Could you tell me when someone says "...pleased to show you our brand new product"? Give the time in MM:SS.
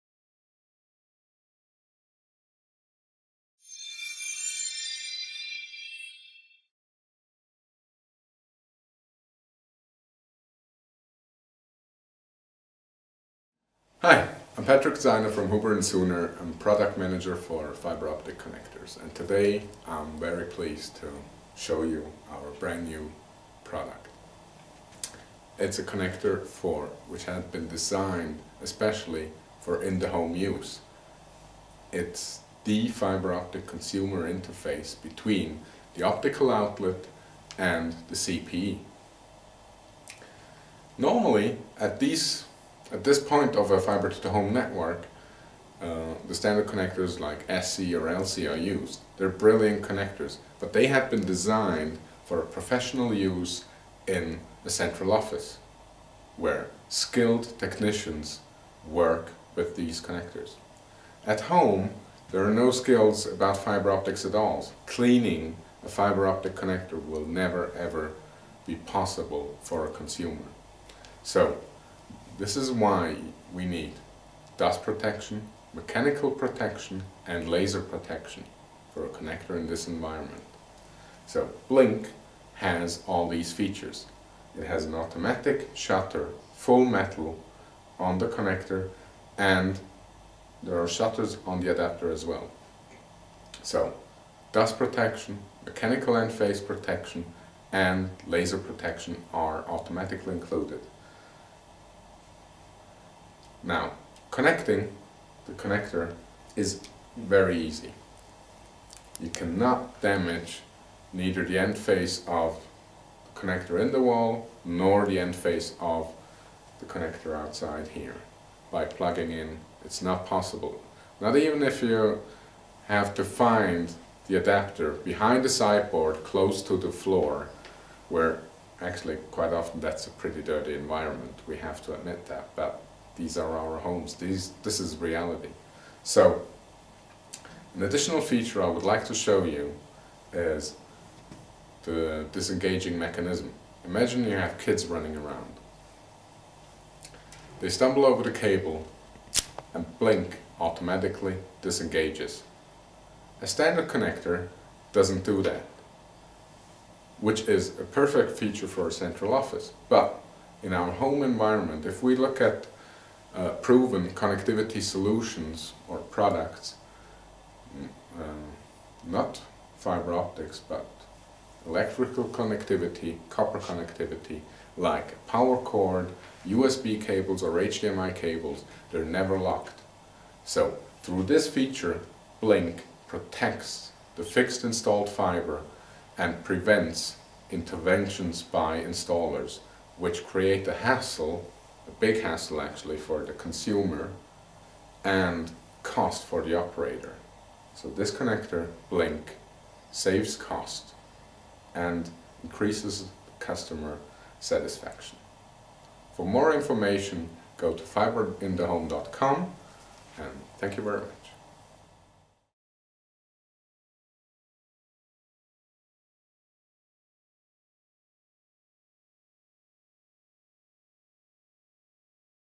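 00:20.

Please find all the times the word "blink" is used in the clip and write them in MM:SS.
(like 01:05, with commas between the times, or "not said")
01:21, 02:29, 03:02, 03:18.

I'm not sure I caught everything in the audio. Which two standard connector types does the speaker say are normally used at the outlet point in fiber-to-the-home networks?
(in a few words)
SC or LC.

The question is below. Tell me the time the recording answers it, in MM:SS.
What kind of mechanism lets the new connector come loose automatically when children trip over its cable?
02:22.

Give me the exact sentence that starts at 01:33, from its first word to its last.
So dust protection, mechanical and phase protection and laser protection are automatically included.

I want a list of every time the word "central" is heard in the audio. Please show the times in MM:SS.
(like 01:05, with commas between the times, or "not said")
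00:54, 02:38.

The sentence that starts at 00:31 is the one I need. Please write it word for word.
It's the fiber optic consumer interface between the optical outlet and the CPE.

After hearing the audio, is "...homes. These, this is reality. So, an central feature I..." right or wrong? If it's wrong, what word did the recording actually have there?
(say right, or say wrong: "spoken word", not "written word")
wrong: "additional", not "central".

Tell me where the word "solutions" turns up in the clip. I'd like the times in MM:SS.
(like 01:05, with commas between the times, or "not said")
02:44.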